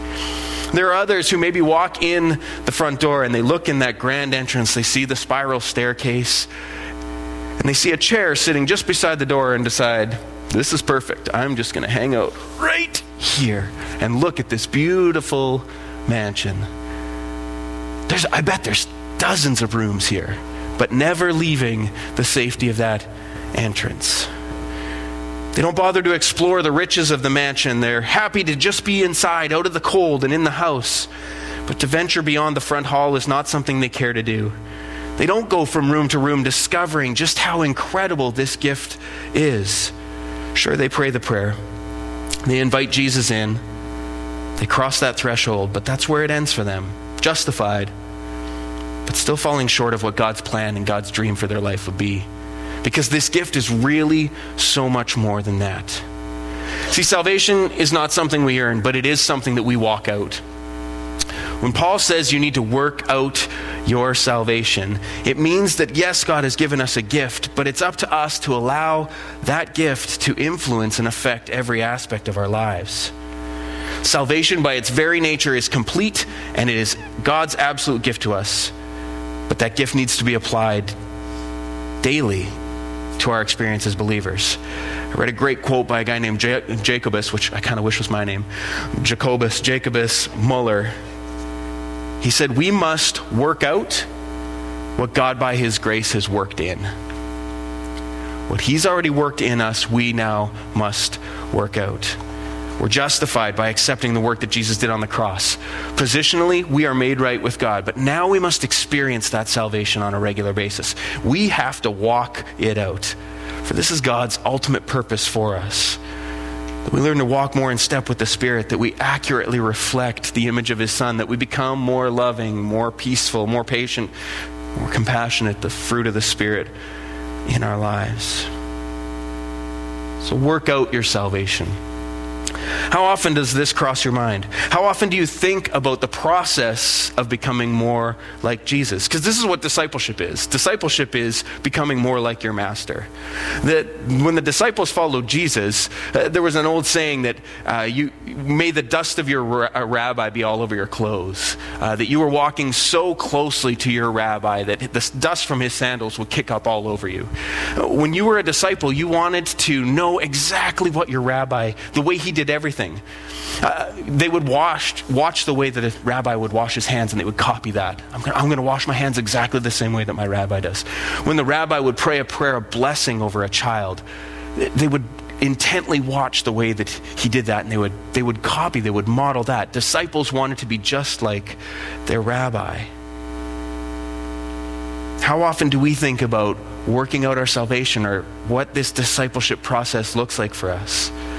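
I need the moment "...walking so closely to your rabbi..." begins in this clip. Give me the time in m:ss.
2:32.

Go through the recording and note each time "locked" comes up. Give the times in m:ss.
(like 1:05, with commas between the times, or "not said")
not said.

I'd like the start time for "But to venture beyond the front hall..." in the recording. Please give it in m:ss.
0:31.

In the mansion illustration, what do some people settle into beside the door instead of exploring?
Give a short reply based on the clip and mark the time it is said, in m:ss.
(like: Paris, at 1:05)
A chair, at 0:07.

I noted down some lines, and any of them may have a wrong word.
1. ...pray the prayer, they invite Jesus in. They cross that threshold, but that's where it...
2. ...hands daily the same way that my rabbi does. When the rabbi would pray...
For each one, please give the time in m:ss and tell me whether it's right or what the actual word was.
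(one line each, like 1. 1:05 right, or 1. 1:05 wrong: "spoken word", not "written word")
1. 0:40 right
2. 2:48 wrong: "exactly", not "daily".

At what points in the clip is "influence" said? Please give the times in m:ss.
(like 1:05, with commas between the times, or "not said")
1:10.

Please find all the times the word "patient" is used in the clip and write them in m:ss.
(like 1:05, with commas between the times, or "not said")
2:03.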